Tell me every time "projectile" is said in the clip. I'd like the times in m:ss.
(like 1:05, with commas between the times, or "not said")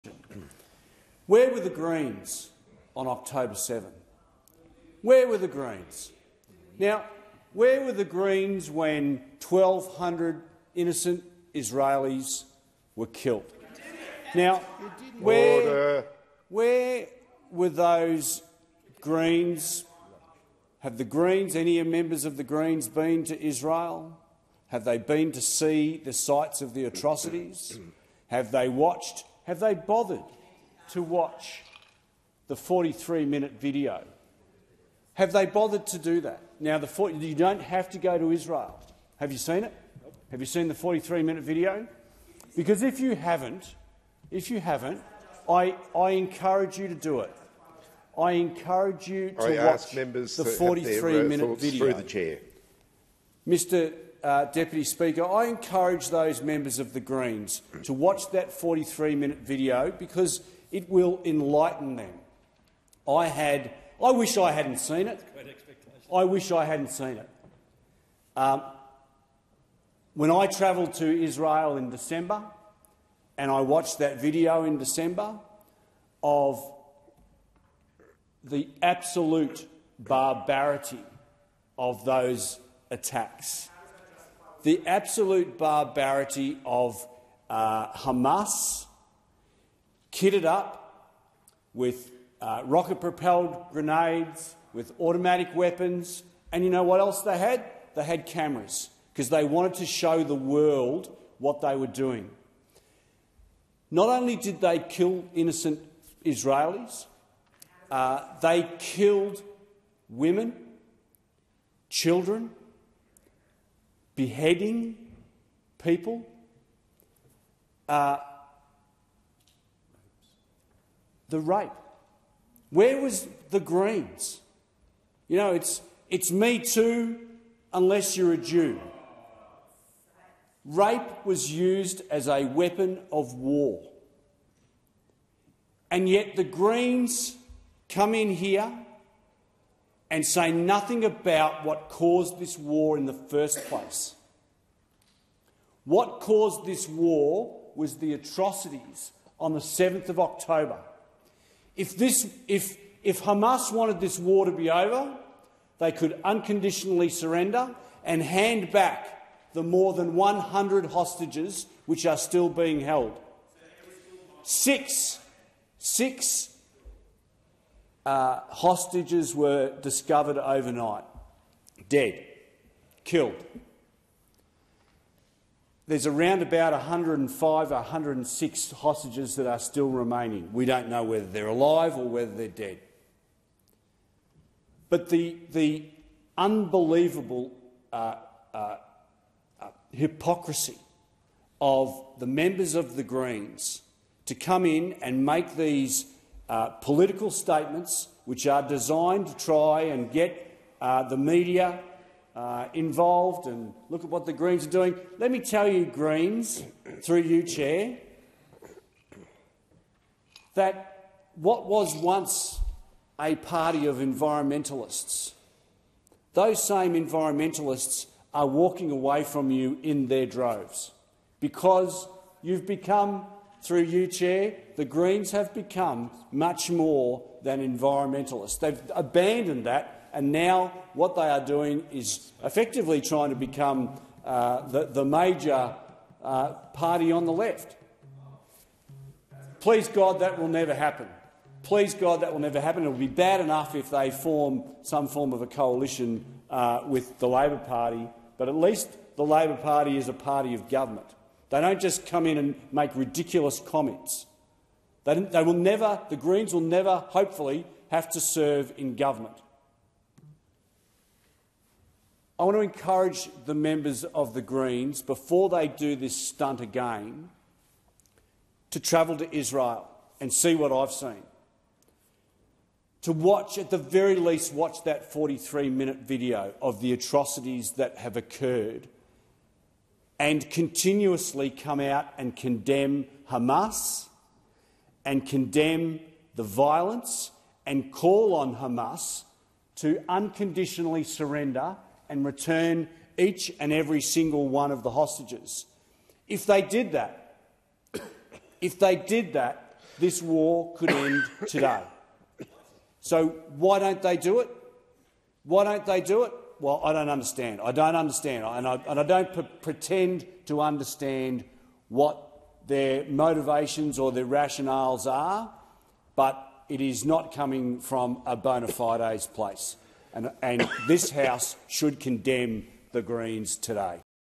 not said.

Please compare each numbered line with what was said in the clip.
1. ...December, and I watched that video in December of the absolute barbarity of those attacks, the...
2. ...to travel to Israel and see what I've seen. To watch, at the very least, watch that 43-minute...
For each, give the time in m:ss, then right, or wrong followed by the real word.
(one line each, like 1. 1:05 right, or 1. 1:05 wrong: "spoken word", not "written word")
1. 1:11 right
2. 4:28 right.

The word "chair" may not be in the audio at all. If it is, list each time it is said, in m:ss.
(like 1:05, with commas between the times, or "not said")
0:52, 3:27, 3:44.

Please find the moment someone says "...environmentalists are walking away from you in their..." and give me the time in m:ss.
3:36.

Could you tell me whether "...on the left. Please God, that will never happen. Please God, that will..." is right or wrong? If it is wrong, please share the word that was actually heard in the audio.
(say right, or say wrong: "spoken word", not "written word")
right.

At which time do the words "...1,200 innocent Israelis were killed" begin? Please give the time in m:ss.
0:09.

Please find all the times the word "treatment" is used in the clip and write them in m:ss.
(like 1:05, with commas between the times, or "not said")
not said.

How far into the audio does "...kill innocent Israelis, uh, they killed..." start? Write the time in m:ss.
1:44.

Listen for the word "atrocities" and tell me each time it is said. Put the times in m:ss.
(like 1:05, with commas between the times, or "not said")
0:26, 2:28, 4:36.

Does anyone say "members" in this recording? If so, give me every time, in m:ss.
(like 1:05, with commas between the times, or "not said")
0:21, 0:56, 3:12, 4:23.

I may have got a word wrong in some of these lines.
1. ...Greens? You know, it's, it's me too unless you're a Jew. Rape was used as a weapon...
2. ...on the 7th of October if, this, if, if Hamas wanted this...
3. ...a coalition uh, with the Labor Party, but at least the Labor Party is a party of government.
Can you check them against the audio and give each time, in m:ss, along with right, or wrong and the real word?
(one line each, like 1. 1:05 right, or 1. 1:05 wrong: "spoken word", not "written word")
1. 2:03 right
2. 2:29 right
3. 4:05 right.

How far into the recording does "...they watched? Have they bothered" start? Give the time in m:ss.
0:28.